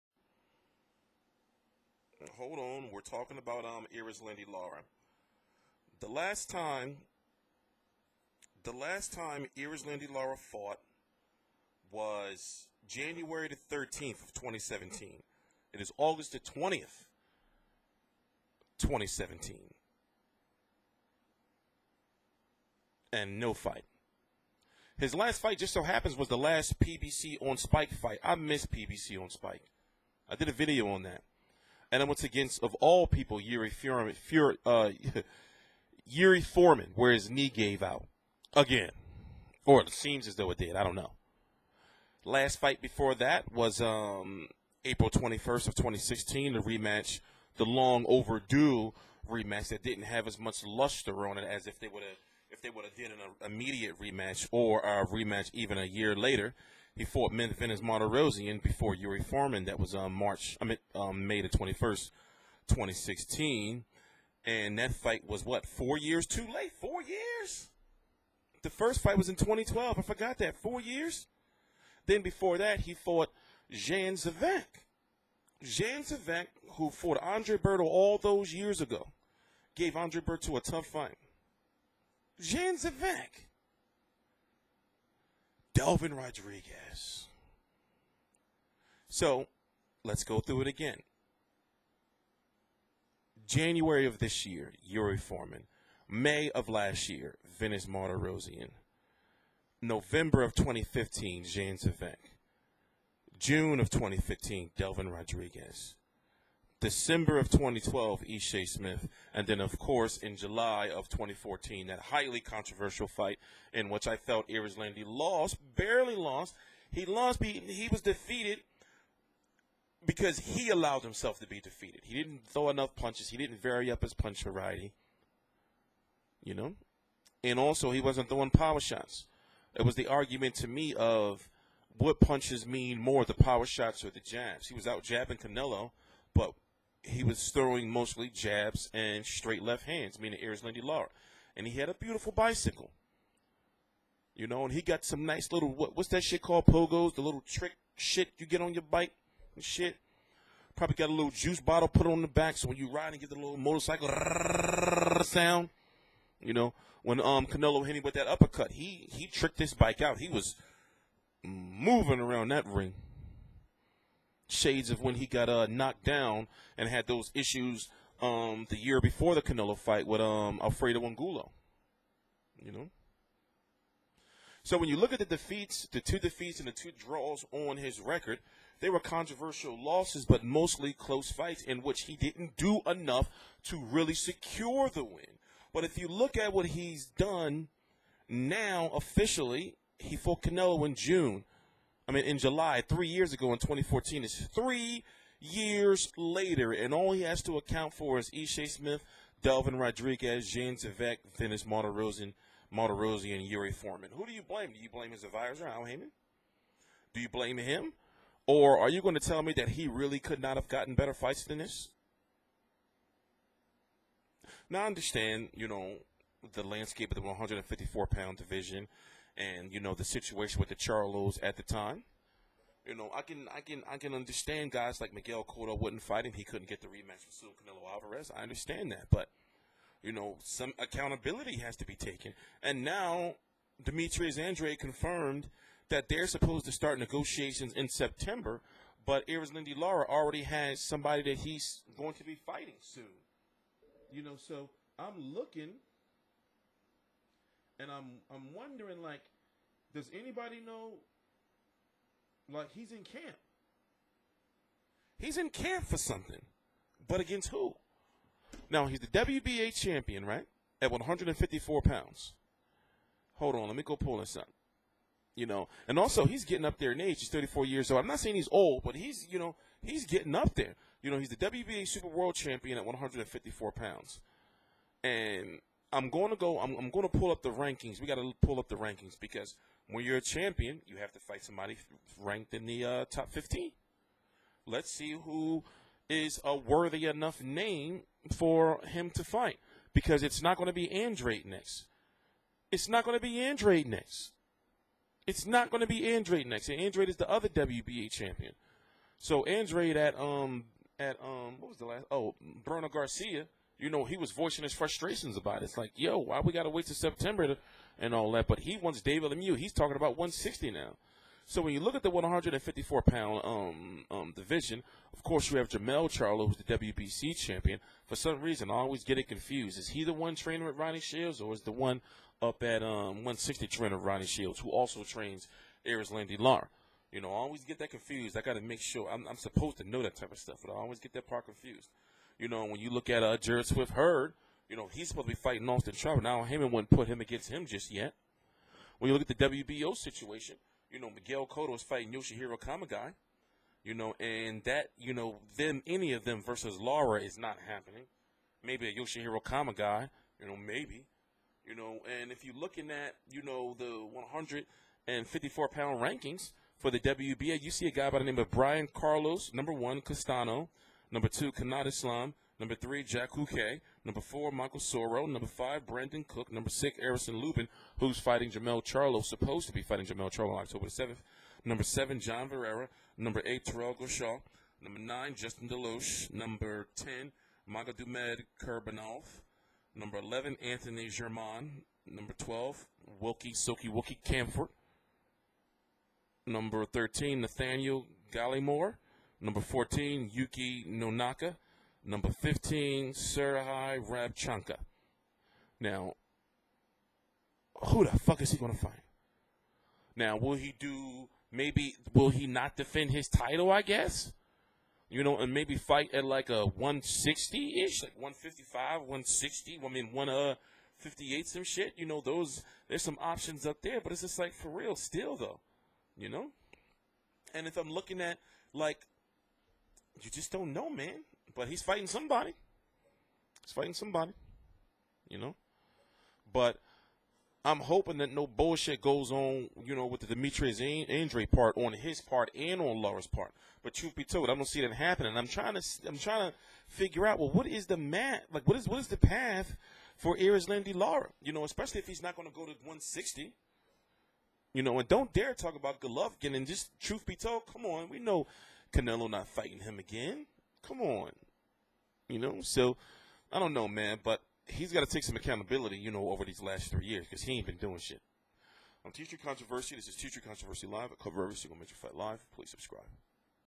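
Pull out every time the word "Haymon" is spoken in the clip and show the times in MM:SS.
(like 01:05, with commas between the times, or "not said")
03:25, 05:36.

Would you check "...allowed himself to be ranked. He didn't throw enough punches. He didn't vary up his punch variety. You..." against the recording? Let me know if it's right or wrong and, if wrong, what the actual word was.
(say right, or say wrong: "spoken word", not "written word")
wrong: "defeated", not "ranked".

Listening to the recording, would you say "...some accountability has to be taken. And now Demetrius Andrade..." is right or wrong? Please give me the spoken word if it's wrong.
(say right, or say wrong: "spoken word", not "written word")
right.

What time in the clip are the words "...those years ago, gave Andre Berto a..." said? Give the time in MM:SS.
01:18.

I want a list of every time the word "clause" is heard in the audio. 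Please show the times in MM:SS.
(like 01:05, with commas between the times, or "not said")
not said.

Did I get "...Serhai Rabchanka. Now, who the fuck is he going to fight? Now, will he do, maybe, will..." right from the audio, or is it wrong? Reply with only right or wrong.
right.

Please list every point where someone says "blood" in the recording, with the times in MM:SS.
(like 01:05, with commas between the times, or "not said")
not said.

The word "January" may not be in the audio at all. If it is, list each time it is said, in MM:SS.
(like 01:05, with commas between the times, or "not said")
00:12, 01:33.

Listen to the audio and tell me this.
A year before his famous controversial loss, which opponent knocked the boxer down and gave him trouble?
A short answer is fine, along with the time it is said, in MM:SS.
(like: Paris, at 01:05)
Alfredo Angulo, at 02:50.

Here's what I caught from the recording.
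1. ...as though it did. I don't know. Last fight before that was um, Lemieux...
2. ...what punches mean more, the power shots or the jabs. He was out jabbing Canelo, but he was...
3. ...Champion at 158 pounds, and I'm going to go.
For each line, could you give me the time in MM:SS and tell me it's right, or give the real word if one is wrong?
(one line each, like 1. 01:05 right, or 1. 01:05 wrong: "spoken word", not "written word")
1. 00:40 wrong: "April", not "Lemieux"
2. 02:11 right
3. 04:32 wrong: "154", not "158".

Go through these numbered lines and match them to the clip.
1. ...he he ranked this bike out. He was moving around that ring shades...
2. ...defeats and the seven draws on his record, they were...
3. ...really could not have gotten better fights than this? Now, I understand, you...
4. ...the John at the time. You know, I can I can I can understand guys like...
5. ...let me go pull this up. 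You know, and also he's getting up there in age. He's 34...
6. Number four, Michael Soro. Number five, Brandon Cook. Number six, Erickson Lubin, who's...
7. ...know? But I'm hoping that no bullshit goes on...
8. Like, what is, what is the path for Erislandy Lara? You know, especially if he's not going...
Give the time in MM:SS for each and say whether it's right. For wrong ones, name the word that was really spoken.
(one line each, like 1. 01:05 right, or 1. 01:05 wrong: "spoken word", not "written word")
1. 02:38 wrong: "tricked", not "ranked"
2. 02:56 wrong: "two", not "seven"
3. 03:29 right
4. 03:40 wrong: "Charlos", not "John"
5. 04:23 right
6. 06:04 right
7. 07:05 right
8. 07:18 right.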